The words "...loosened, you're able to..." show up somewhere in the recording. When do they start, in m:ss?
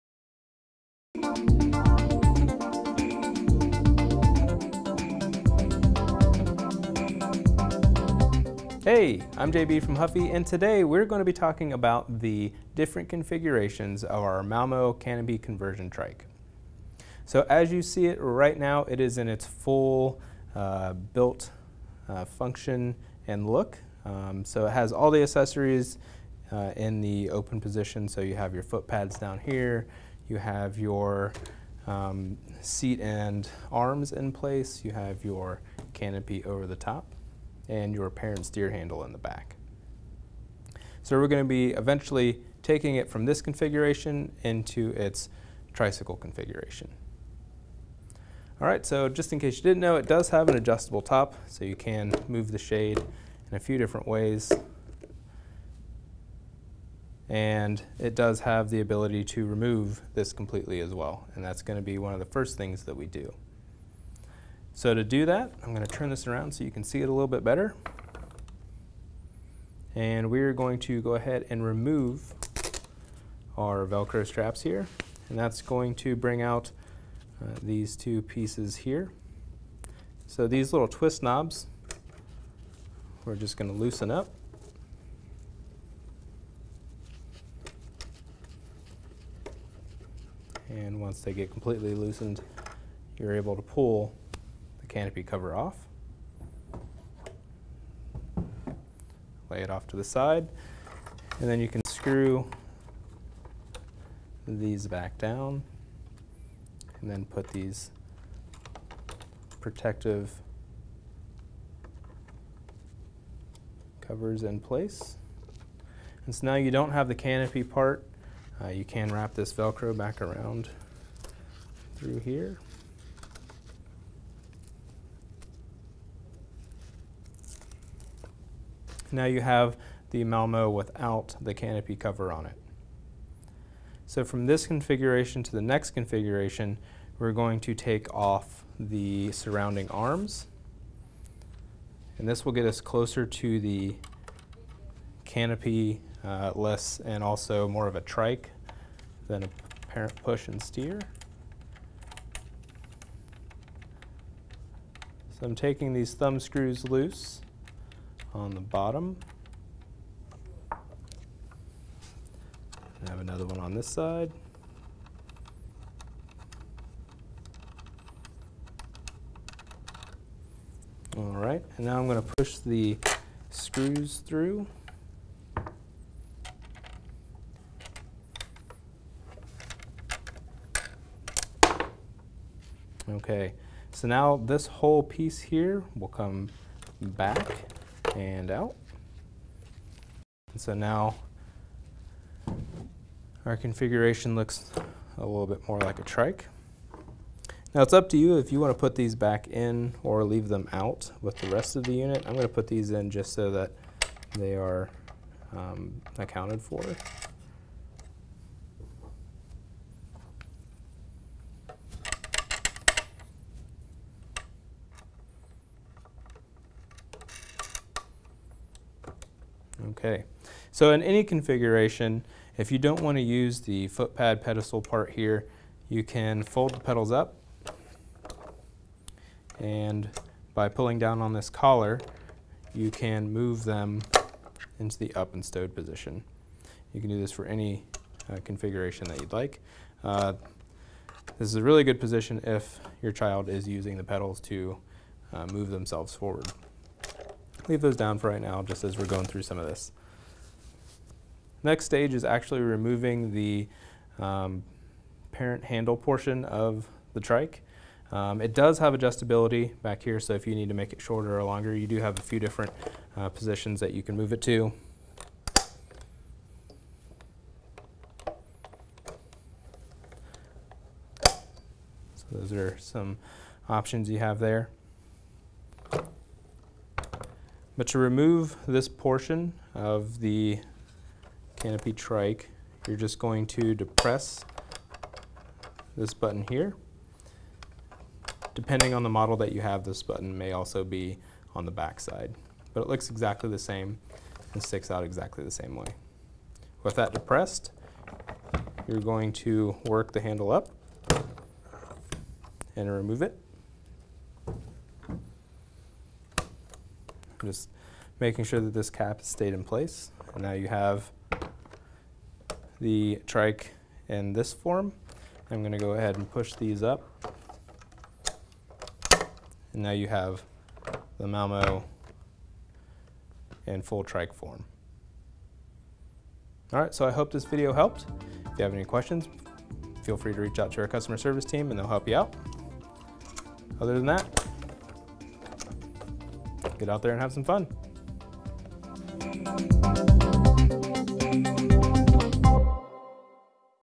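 1:31.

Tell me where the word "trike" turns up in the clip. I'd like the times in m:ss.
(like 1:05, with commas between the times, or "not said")
0:15, 2:28, 3:16, 4:17, 4:41, 5:13, 5:24.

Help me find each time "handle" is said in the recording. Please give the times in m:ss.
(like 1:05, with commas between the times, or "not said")
0:38, 4:15, 5:00.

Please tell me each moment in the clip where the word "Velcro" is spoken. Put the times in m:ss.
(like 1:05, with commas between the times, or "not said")
1:13, 1:59.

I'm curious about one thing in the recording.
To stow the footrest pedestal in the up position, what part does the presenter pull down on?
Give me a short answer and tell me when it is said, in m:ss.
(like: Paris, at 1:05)
collar, at 3:51.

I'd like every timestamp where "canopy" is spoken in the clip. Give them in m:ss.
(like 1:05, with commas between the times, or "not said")
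0:14, 0:35, 1:34, 1:57, 2:11, 2:25, 4:41.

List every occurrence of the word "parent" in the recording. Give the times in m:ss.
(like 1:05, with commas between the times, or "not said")
0:38, 2:29, 4:15.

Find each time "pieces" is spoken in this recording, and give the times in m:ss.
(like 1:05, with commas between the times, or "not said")
1:18, 3:05.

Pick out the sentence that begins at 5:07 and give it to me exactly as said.
I'm just making sure that this cap stayed in place.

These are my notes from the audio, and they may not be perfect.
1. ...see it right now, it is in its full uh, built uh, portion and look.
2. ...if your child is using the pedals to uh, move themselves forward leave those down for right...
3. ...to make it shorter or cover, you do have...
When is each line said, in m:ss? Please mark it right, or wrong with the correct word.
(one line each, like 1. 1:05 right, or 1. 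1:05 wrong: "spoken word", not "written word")
1. 0:17 wrong: "function", not "portion"
2. 4:02 right
3. 4:20 wrong: "longer", not "cover".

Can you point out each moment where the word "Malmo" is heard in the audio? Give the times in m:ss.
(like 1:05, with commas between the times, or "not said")
0:14, 2:10, 5:21.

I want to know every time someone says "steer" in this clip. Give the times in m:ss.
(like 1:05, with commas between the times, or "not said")
0:38, 2:30.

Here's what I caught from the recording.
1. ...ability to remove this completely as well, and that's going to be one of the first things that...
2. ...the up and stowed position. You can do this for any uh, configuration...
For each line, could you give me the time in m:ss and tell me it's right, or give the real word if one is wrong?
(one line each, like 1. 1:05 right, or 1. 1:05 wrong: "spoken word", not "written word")
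1. 0:58 right
2. 3:54 right.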